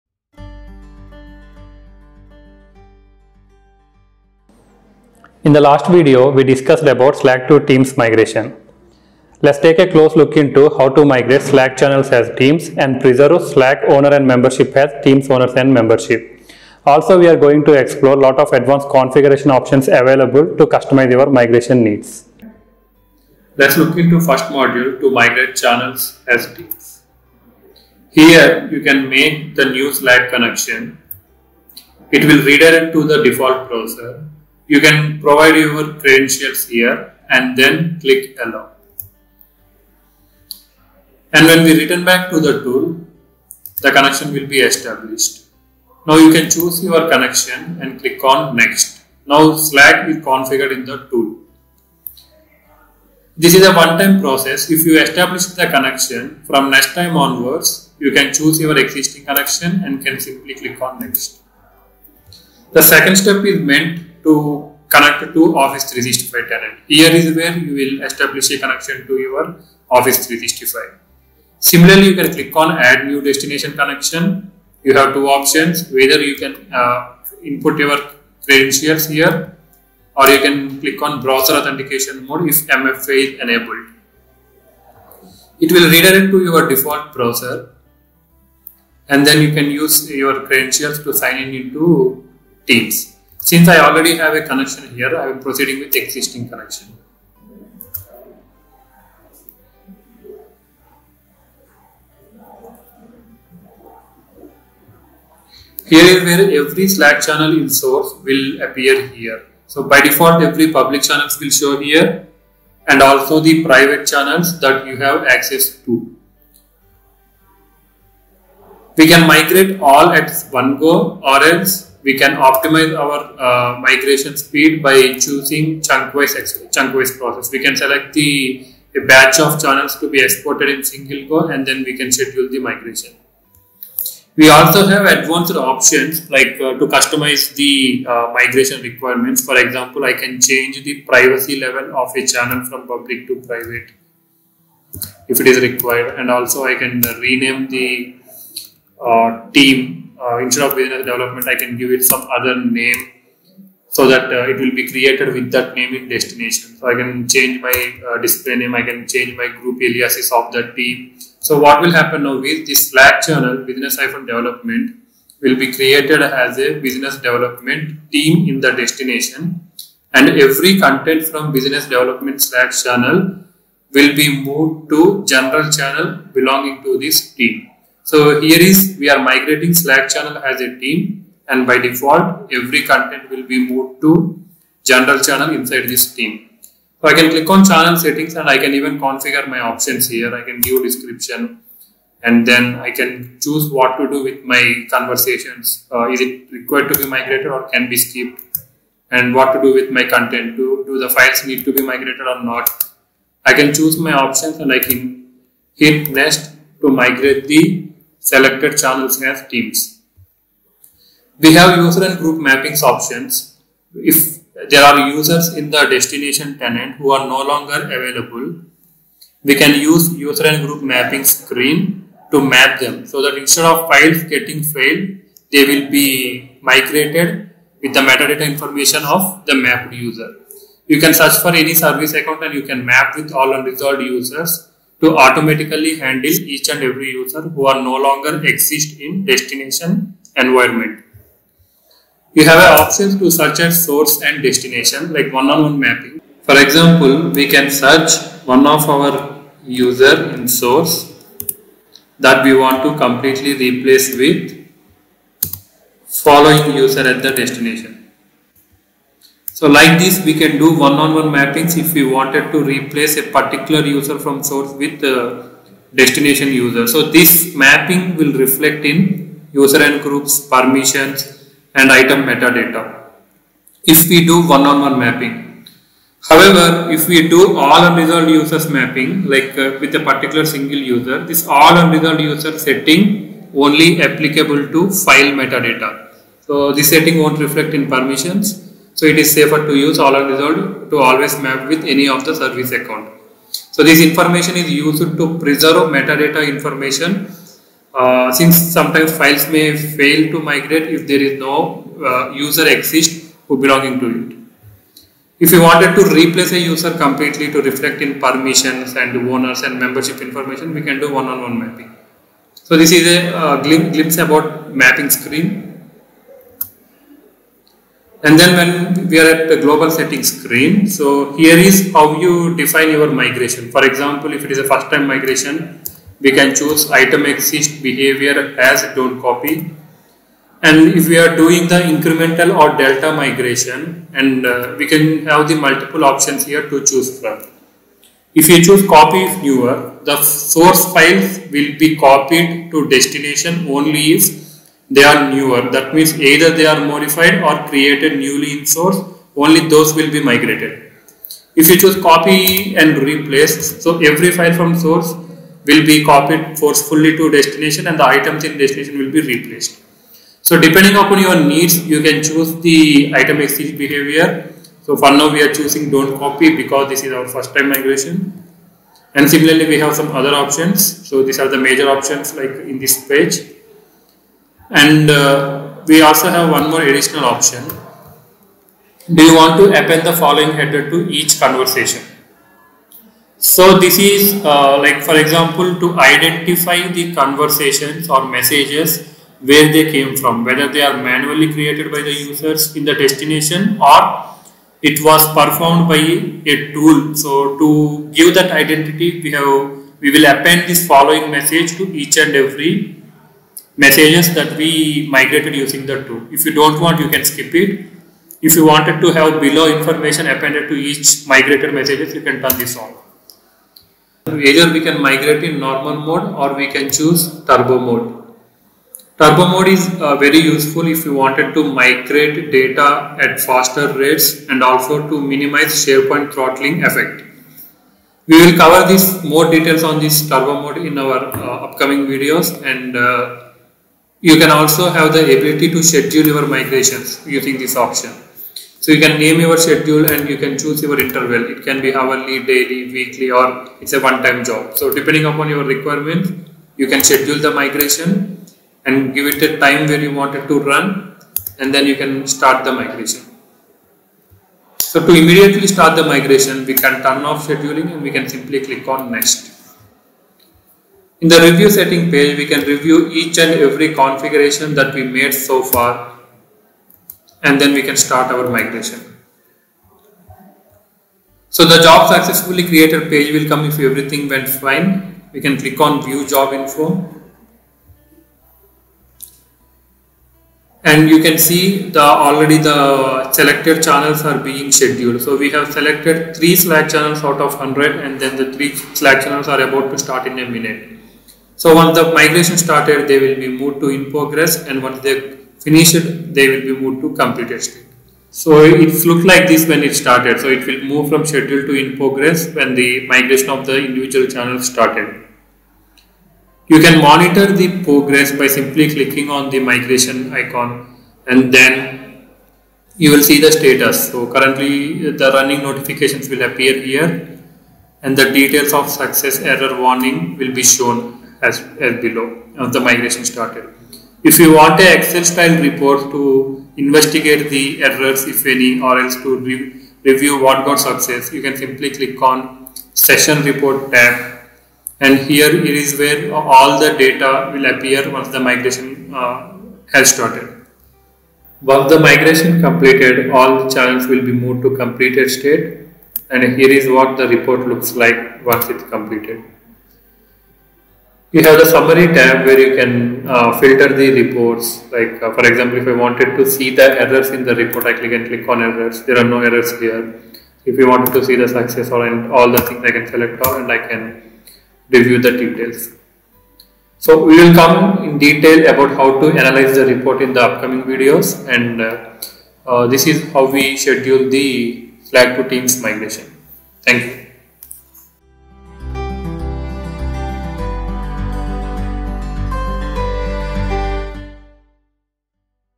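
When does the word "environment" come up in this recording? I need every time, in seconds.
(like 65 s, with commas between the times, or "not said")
240 s.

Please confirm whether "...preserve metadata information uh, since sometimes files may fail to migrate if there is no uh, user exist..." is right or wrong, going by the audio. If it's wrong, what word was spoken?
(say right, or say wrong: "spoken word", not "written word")
right.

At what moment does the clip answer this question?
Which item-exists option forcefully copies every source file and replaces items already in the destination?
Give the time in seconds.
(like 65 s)
352 s.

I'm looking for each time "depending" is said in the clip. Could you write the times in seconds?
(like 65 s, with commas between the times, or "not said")
360 s, 444 s.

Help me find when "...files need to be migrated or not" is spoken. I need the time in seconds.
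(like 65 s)
201 s.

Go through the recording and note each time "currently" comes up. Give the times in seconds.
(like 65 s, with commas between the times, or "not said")
514 s.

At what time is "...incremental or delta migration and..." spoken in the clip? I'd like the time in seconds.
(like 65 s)
331 s.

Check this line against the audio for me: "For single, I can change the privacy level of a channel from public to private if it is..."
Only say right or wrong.
wrong.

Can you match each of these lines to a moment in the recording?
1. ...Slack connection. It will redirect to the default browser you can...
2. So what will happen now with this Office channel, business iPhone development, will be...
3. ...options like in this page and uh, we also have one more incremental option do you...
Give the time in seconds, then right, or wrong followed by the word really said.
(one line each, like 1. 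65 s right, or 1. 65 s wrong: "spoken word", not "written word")
1. 29 s right
2. 161 s wrong: "Slack", not "Office"
3. 371 s wrong: "additional", not "incremental".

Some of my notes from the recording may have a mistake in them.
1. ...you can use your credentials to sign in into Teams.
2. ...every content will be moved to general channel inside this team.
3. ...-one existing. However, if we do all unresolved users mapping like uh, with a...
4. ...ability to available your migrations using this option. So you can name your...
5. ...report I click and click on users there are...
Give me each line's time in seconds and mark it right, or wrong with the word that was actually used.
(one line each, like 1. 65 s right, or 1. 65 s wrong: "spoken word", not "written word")
1. 89 s right
2. 182 s right
3. 274 s wrong: "mapping", not "existing"
4. 435 s wrong: "schedule", not "available"
5. 557 s wrong: "errors", not "users".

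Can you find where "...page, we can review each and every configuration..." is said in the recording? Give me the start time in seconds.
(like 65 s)
462 s.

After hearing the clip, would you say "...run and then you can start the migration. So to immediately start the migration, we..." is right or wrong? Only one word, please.
right.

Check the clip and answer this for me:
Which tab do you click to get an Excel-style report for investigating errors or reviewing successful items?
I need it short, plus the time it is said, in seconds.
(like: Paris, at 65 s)
session report, at 532 s.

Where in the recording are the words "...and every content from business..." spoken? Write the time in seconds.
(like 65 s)
170 s.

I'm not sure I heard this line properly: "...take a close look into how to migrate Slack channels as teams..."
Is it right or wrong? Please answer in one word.
right.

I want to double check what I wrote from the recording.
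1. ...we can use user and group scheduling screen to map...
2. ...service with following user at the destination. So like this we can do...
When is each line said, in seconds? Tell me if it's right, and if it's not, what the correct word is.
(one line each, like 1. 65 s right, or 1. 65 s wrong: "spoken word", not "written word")
1. 219 s wrong: "mapping", not "scheduling"
2. 253 s wrong: "replace", not "service".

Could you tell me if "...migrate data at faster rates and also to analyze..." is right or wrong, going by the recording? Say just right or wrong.
wrong.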